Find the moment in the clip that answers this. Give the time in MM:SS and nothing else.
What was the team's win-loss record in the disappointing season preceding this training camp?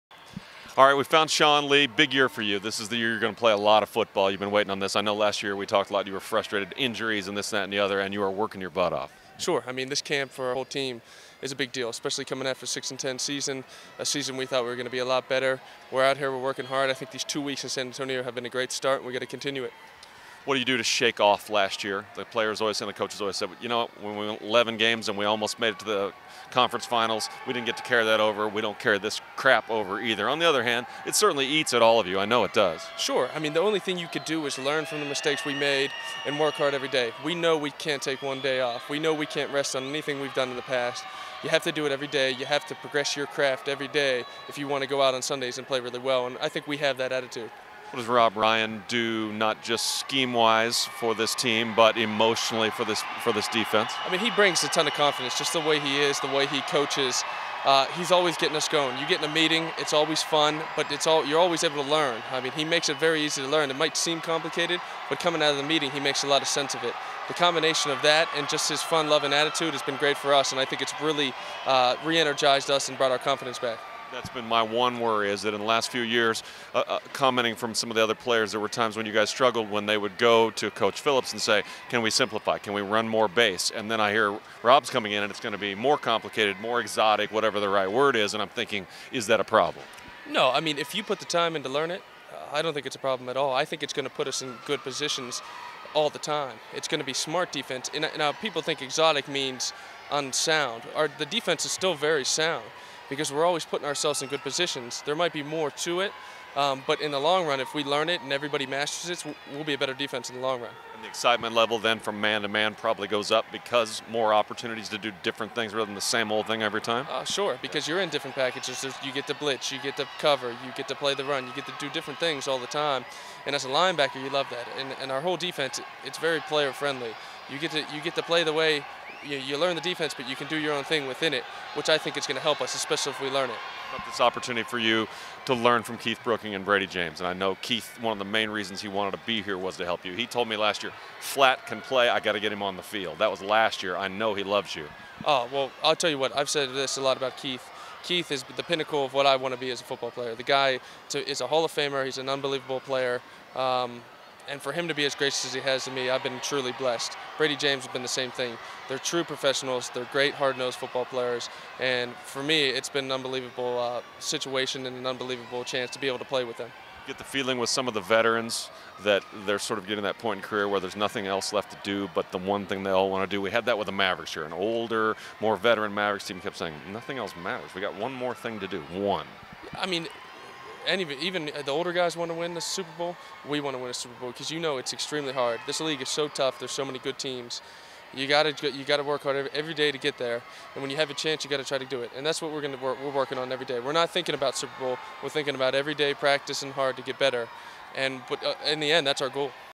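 00:12.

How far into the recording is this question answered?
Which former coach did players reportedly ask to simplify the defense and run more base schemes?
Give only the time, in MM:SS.
01:20.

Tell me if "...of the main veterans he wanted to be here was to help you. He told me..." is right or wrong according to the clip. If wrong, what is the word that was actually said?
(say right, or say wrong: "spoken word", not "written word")
wrong: "reasons", not "veterans".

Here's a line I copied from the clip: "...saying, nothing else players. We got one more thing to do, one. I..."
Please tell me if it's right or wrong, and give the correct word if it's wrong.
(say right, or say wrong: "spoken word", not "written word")
wrong: "matters", not "players".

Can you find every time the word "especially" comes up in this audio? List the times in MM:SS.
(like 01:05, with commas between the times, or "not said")
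00:11, 02:12.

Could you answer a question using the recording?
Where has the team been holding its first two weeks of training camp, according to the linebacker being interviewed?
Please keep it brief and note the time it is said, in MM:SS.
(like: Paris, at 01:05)
San Antonio, at 00:17.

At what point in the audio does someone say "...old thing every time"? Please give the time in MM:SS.
01:56.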